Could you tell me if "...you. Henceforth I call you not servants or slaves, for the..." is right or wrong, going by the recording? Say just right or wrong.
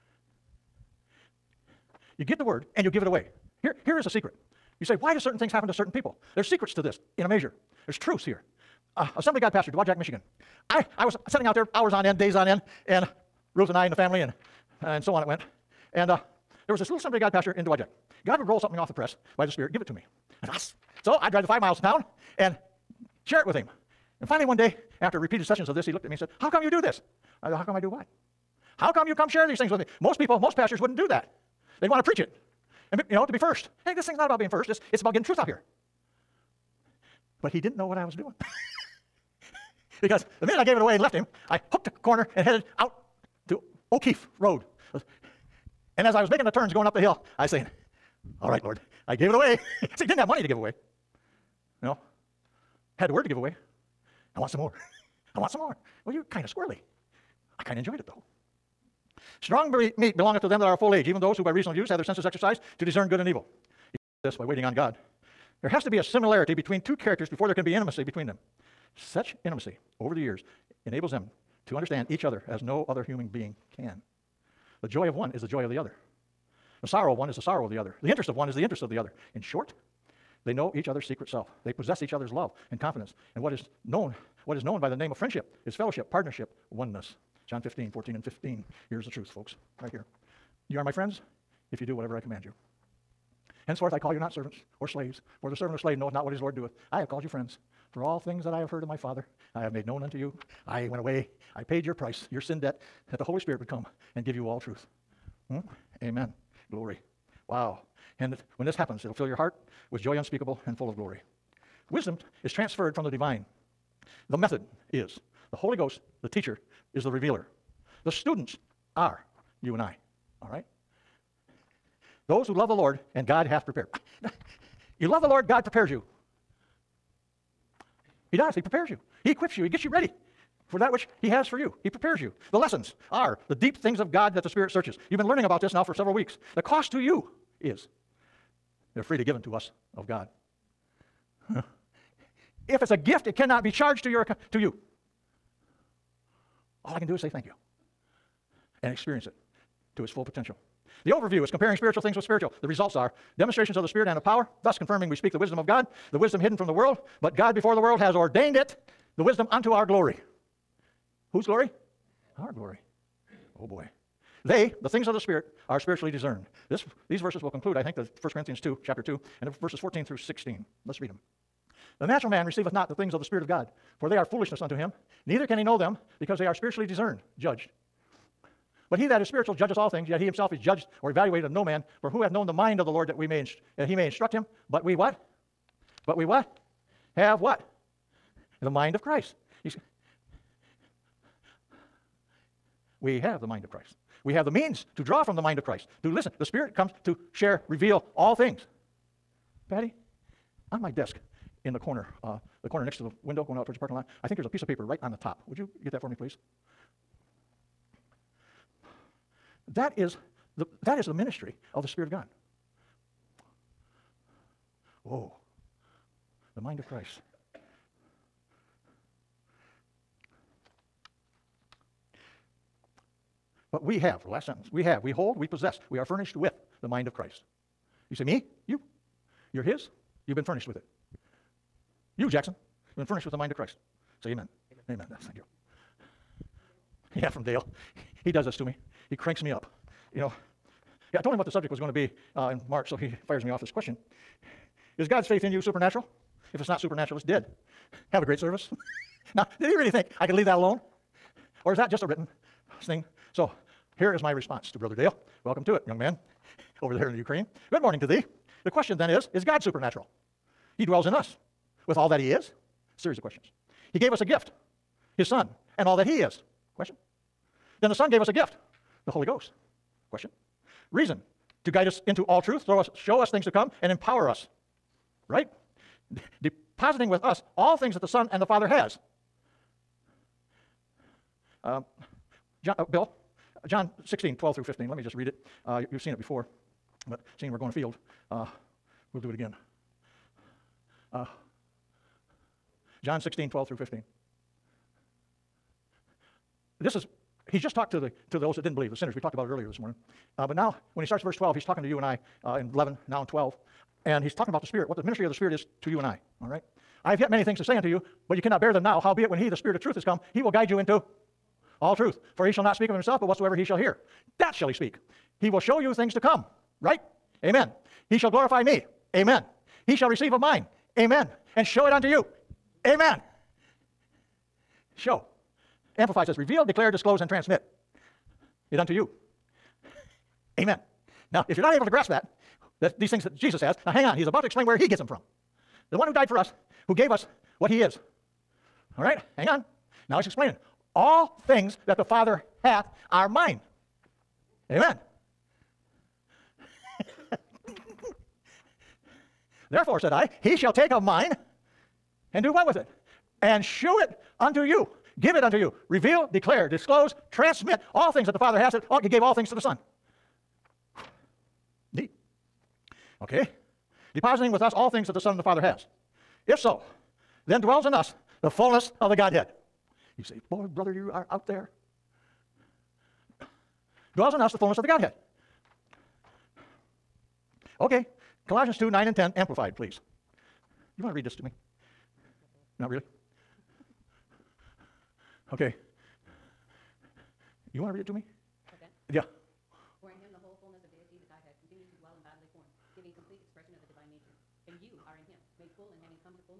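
right.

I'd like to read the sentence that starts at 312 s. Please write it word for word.
For He shall not speak of Himself, but whatsoever He shall hear, that shall He speak.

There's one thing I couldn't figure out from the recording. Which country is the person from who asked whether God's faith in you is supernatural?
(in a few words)
Ukraine.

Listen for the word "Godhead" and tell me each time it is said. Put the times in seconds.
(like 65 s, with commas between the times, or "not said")
369 s, 374 s.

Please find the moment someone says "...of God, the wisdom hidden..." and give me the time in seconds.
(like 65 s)
155 s.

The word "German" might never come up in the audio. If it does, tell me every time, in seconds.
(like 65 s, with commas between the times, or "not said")
not said.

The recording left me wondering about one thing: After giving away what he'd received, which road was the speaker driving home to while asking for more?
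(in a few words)
O'Keefe Road.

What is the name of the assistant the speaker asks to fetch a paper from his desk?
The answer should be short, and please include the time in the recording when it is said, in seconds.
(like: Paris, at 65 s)
Patty, at 199 s.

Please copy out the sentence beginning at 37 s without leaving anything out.
But he didn't know what I was doing.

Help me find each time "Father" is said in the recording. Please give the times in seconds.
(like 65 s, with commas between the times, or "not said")
98 s, 278 s, 342 s, 358 s, 365 s.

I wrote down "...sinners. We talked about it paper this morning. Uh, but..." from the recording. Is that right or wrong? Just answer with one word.
wrong.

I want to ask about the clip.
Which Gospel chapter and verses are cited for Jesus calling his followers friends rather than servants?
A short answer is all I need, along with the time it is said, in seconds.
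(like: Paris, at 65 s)
John 15:14-15, at 87 s.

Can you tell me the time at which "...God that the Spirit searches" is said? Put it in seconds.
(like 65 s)
134 s.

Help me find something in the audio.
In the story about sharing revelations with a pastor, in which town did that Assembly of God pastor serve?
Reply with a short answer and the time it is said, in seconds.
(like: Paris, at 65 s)
Dowagiac, Michigan, at 9 s.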